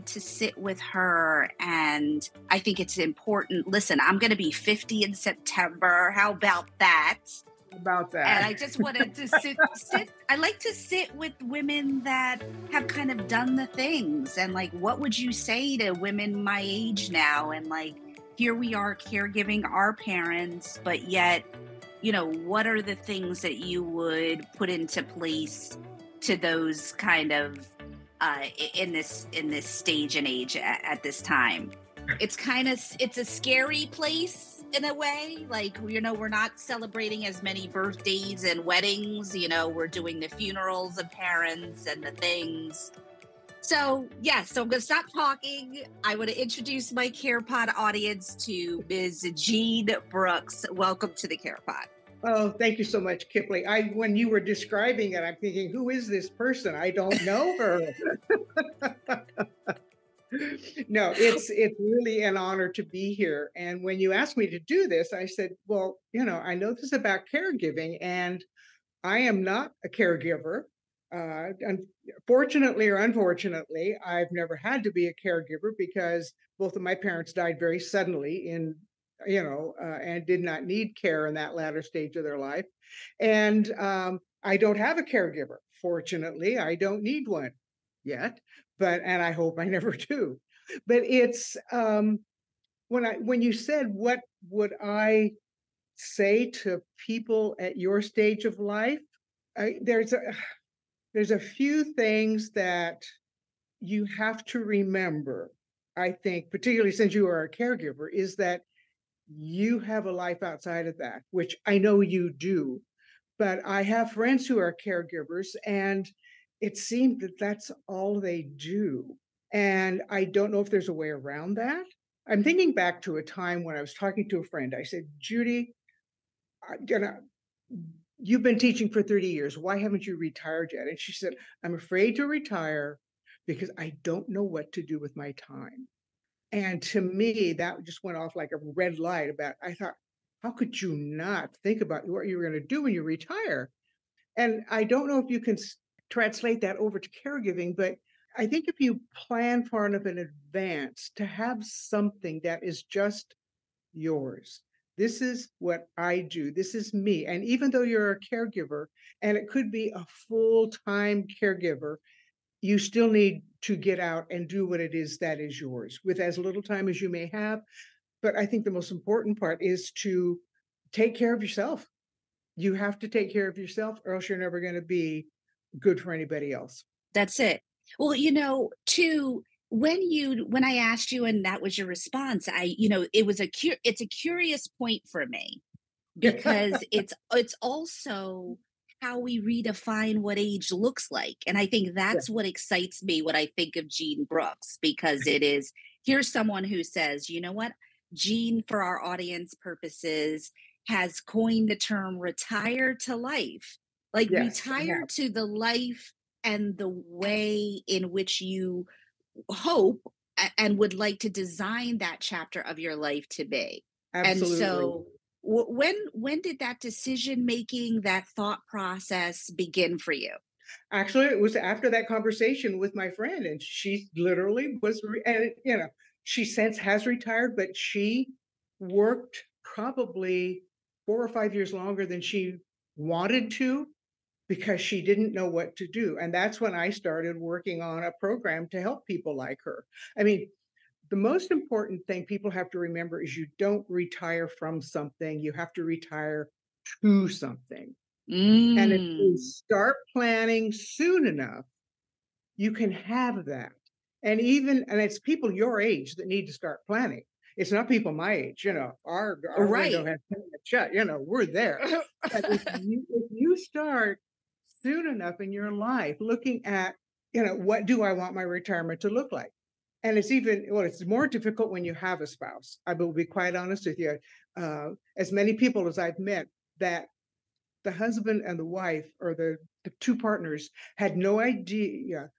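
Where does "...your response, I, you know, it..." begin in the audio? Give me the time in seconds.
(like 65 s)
181 s.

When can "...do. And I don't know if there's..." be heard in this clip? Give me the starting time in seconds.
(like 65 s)
118 s.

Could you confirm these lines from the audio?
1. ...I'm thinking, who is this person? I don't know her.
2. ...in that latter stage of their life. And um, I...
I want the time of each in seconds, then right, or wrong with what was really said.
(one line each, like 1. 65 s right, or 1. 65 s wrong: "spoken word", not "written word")
1. 55 s right
2. 81 s right.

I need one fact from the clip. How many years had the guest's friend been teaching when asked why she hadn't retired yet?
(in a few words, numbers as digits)
30.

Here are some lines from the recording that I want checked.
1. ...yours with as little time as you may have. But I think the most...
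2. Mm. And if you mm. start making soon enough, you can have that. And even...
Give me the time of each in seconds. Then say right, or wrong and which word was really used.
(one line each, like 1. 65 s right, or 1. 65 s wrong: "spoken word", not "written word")
1. 165 s right
2. 248 s wrong: "planning", not "making".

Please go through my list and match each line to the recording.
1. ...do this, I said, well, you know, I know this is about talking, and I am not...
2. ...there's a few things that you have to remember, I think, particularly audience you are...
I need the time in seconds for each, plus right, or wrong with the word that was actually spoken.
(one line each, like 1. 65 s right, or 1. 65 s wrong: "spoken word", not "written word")
1. 64 s wrong: "caregiving", not "talking"
2. 101 s wrong: "since", not "audience".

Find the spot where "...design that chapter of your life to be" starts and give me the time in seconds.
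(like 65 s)
211 s.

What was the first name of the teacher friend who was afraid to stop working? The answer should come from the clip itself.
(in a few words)
Judy.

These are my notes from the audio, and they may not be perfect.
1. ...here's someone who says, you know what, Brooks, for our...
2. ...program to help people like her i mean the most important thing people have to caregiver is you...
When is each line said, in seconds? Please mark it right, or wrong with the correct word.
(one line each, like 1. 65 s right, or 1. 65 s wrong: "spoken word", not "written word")
1. 196 s wrong: "Jean", not "Brooks"
2. 238 s wrong: "remember", not "caregiver".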